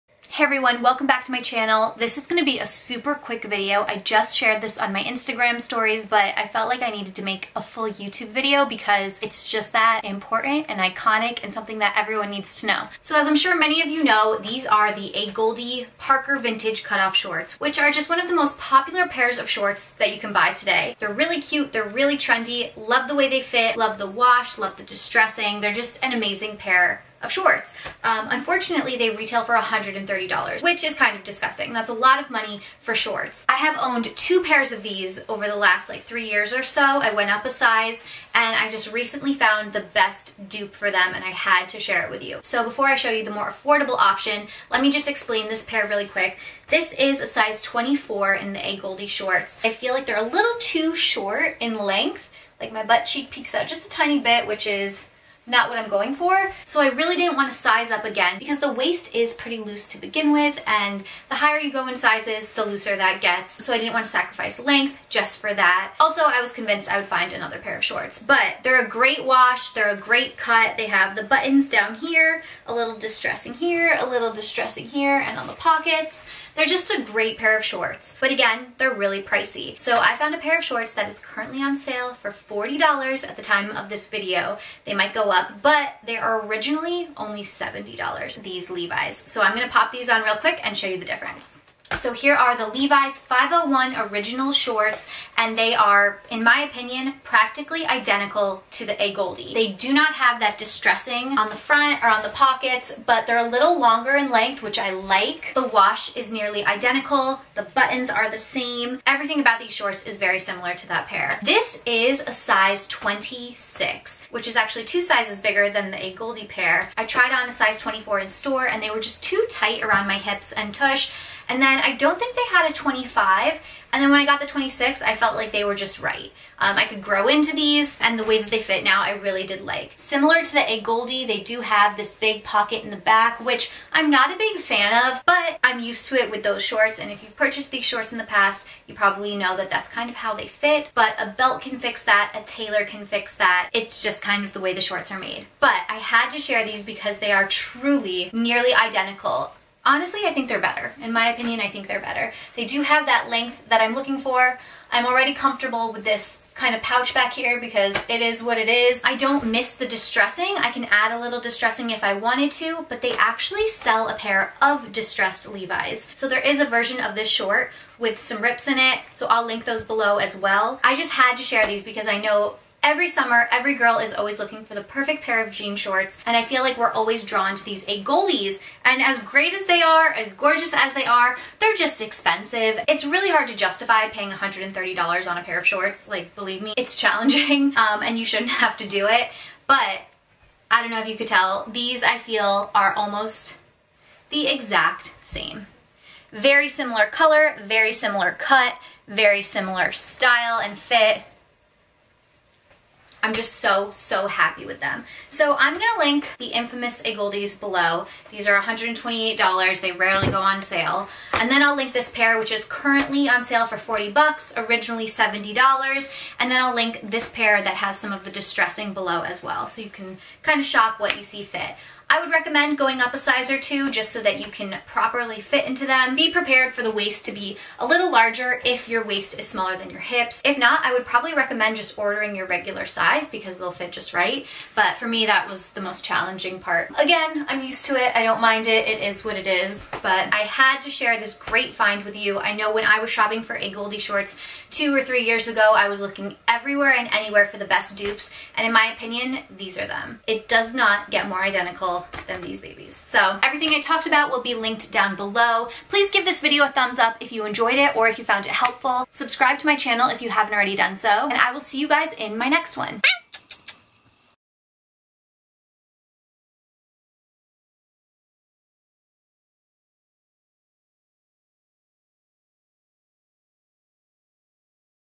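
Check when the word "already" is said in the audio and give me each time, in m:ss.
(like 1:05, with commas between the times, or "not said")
2:35, 4:20.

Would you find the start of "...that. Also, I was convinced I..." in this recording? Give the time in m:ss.
1:05.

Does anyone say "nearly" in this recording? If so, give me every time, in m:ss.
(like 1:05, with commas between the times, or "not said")
1:46, 2:28.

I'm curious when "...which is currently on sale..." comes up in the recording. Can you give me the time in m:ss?
3:32.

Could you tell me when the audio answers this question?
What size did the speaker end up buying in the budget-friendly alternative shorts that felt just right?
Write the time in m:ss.
1:52.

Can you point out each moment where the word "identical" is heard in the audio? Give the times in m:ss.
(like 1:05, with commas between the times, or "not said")
1:37, 1:46, 2:28, 4:11.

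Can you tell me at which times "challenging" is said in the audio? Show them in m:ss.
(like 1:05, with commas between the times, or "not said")
3:06, 3:56.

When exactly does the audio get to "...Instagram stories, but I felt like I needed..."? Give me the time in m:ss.
0:05.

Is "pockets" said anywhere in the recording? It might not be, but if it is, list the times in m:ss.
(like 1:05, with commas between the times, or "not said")
1:15, 1:42, 2:12.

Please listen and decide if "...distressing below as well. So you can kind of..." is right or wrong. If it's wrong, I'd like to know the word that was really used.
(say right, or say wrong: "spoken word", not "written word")
right.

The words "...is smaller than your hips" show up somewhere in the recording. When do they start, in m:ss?
3:49.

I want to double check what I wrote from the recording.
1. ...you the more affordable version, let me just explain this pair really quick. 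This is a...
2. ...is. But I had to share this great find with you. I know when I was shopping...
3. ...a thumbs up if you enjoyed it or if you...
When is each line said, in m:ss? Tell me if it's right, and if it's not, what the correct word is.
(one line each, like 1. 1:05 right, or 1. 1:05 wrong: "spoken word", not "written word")
1. 0:43 wrong: "option", not "version"
2. 3:59 right
3. 4:16 right.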